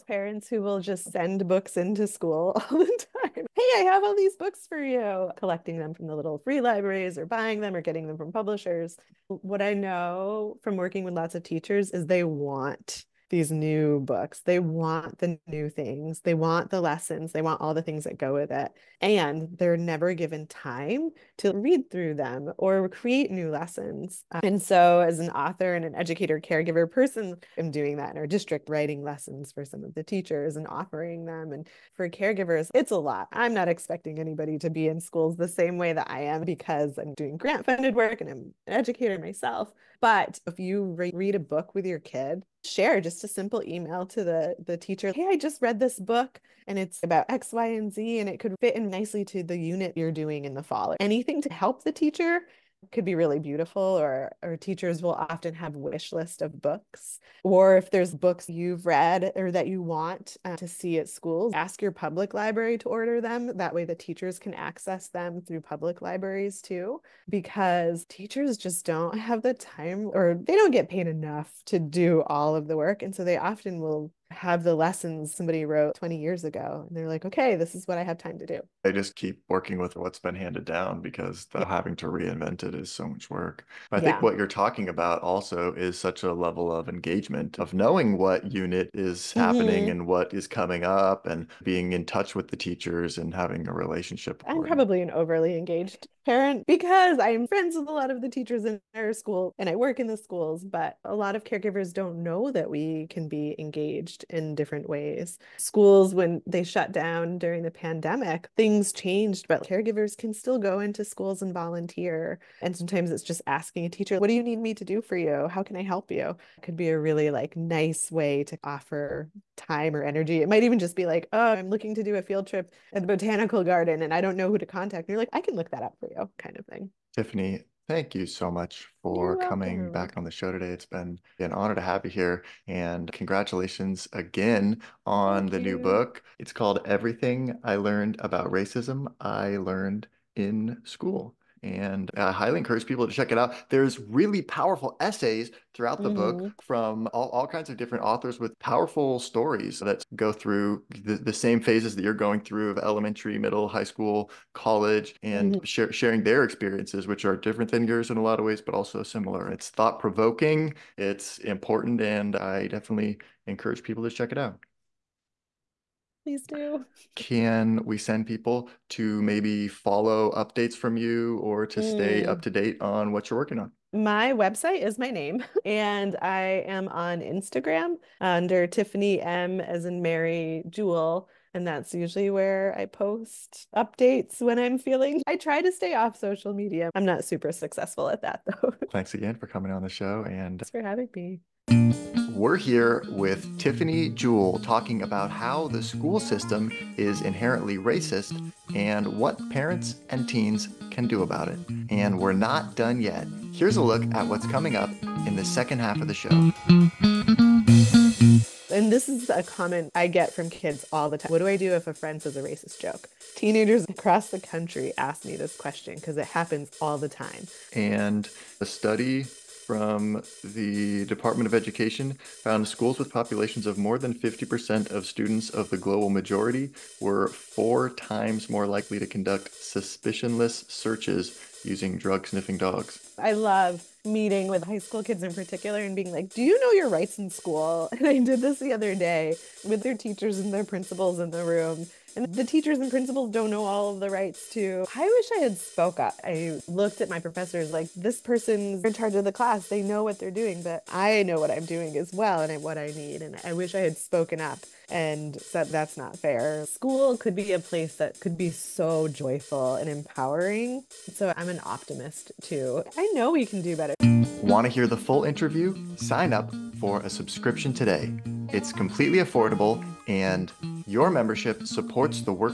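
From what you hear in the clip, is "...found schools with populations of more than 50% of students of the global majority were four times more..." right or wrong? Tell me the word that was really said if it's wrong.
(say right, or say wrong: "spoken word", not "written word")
right.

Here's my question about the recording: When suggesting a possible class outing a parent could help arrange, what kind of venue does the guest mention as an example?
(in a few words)
botanical garden.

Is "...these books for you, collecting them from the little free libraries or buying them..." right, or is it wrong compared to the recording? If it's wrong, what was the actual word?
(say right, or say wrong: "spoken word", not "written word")
right.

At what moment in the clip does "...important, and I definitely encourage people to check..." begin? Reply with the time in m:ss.
2:41.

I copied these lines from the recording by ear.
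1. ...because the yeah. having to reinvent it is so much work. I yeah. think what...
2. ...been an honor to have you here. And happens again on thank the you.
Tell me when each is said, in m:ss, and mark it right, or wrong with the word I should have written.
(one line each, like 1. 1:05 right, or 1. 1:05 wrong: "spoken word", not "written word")
1. 1:21 right
2. 2:10 wrong: "congratulations", not "happens".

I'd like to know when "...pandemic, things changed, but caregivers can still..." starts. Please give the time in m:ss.
1:47.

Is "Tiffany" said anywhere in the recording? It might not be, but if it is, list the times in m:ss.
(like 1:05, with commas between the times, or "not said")
2:07, 2:58, 3:13.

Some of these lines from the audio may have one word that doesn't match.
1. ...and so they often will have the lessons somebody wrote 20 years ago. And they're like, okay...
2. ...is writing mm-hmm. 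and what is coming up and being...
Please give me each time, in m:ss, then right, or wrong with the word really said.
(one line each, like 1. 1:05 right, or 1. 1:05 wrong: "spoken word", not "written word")
1. 1:13 right
2. 1:28 wrong: "happening", not "writing".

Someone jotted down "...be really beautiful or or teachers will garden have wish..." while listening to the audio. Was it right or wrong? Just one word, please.
wrong.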